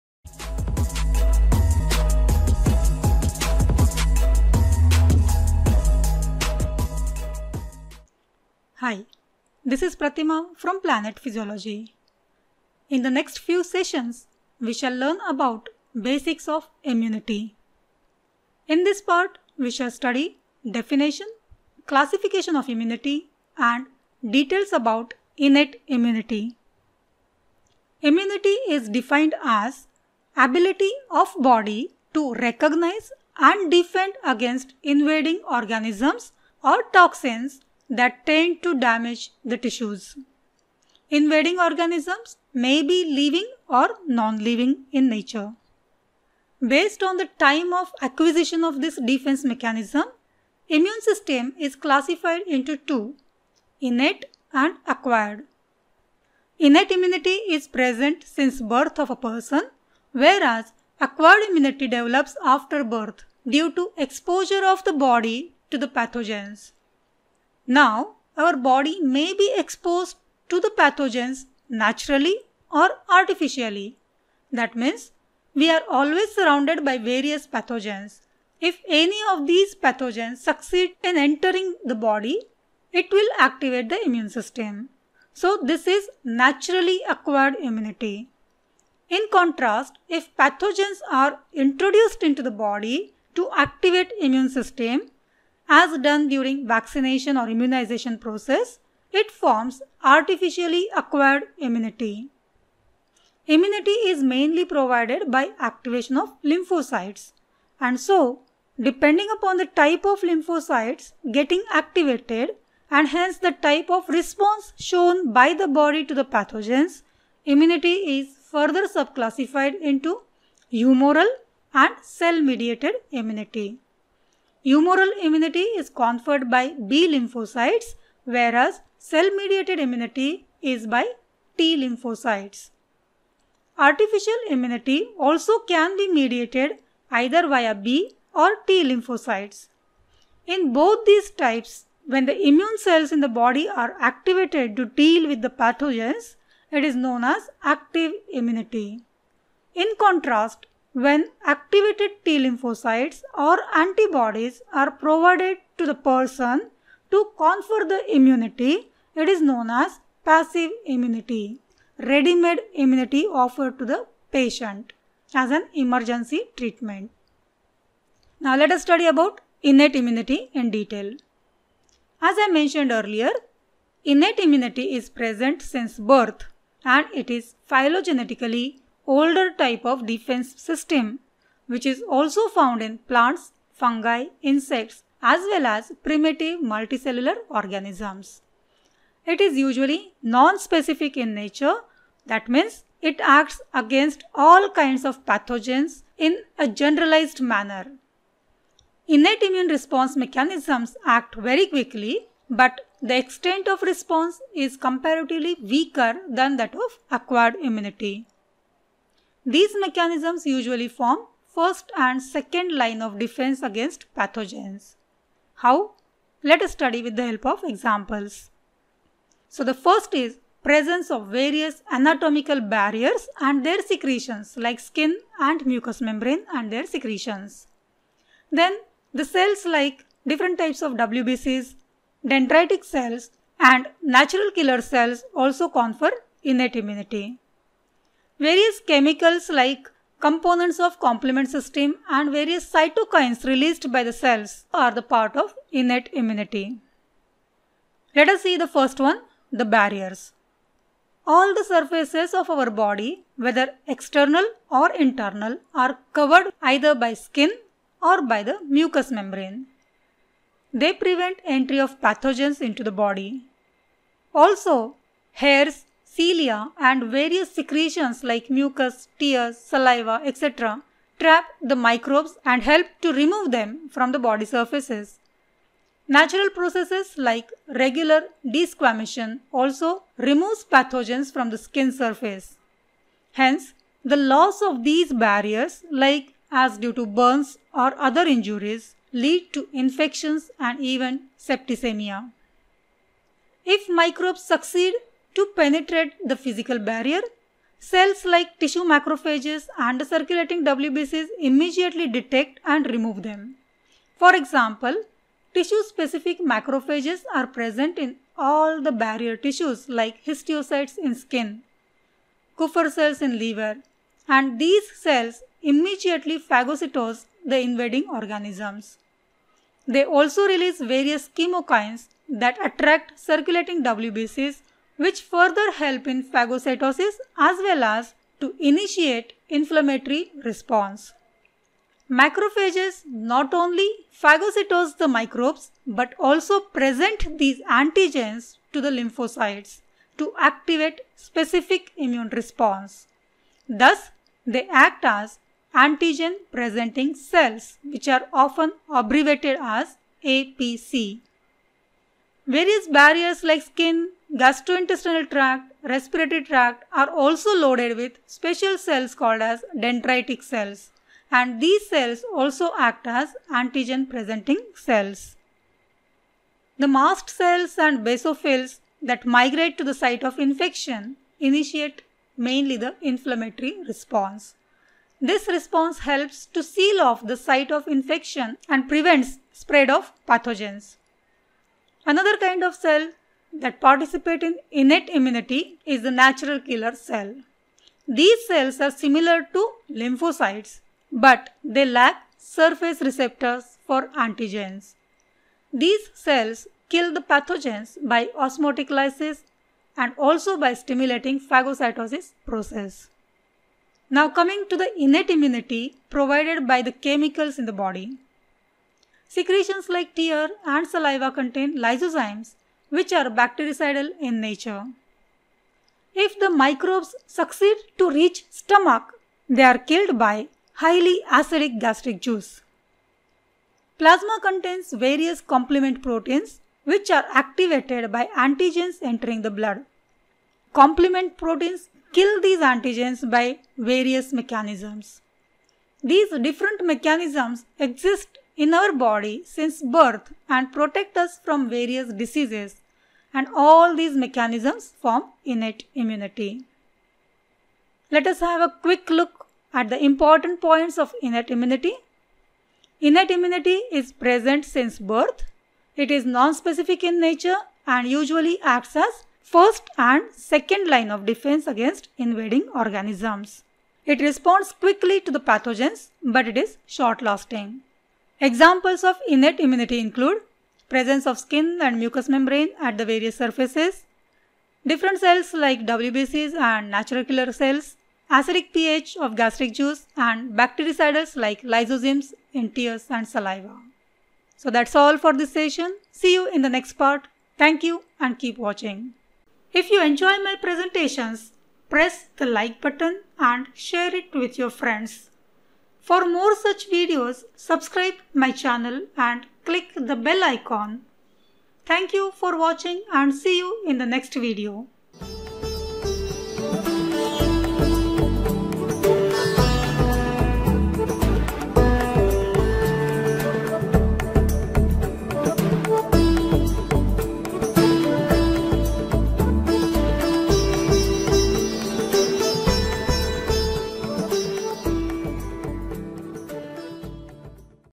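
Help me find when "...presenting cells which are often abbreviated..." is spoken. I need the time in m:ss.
5:46.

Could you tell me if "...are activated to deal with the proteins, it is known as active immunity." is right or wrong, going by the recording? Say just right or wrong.
wrong.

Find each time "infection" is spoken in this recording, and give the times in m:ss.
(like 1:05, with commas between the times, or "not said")
4:49, 6:10, 6:17.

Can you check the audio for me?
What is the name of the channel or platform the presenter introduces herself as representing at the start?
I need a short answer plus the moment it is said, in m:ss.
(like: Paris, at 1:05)
Planet Physiology, at 0:10.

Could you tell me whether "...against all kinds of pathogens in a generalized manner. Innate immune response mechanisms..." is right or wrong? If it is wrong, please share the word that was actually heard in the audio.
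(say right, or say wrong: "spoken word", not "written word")
right.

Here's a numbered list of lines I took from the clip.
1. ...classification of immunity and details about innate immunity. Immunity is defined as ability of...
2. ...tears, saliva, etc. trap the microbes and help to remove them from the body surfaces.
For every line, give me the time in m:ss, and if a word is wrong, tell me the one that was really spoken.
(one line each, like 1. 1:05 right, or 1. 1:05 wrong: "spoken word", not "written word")
1. 0:21 right
2. 4:29 right.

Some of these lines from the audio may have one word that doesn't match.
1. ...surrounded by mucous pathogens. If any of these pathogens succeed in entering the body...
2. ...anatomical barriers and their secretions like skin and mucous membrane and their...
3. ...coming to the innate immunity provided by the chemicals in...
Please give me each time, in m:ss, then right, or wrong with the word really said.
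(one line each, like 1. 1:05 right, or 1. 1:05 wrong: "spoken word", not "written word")
1. 1:16 wrong: "various", not "mucous"
2. 3:41 right
3. 6:44 right.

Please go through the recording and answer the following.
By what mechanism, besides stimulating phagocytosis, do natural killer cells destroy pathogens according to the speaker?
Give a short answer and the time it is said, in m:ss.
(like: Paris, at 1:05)
Osmotic lysis, at 6:38.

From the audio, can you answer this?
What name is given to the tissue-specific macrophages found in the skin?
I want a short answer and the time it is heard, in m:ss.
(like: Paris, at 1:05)
Histiocytes, at 5:10.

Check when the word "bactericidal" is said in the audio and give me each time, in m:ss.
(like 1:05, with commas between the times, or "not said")
6:53, 8:00.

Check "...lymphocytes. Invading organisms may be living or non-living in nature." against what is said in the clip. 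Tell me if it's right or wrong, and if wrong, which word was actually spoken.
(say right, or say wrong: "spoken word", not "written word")
wrong: "tissues", not "lymphocytes".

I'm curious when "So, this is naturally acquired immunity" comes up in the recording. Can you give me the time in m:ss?
1:25.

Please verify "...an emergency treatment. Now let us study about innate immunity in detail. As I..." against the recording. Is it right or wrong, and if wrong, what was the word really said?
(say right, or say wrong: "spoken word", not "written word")
right.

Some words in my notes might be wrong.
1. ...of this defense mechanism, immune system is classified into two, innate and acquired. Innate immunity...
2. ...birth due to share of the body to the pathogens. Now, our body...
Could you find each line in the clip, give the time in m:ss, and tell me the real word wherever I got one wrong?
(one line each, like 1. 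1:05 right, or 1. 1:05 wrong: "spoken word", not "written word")
1. 0:48 right
2. 1:02 wrong: "exposure", not "share".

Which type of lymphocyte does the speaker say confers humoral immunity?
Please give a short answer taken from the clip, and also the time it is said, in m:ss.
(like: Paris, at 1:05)
B lymphocytes, at 2:06.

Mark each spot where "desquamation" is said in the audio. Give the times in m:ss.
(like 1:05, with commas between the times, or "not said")
4:38.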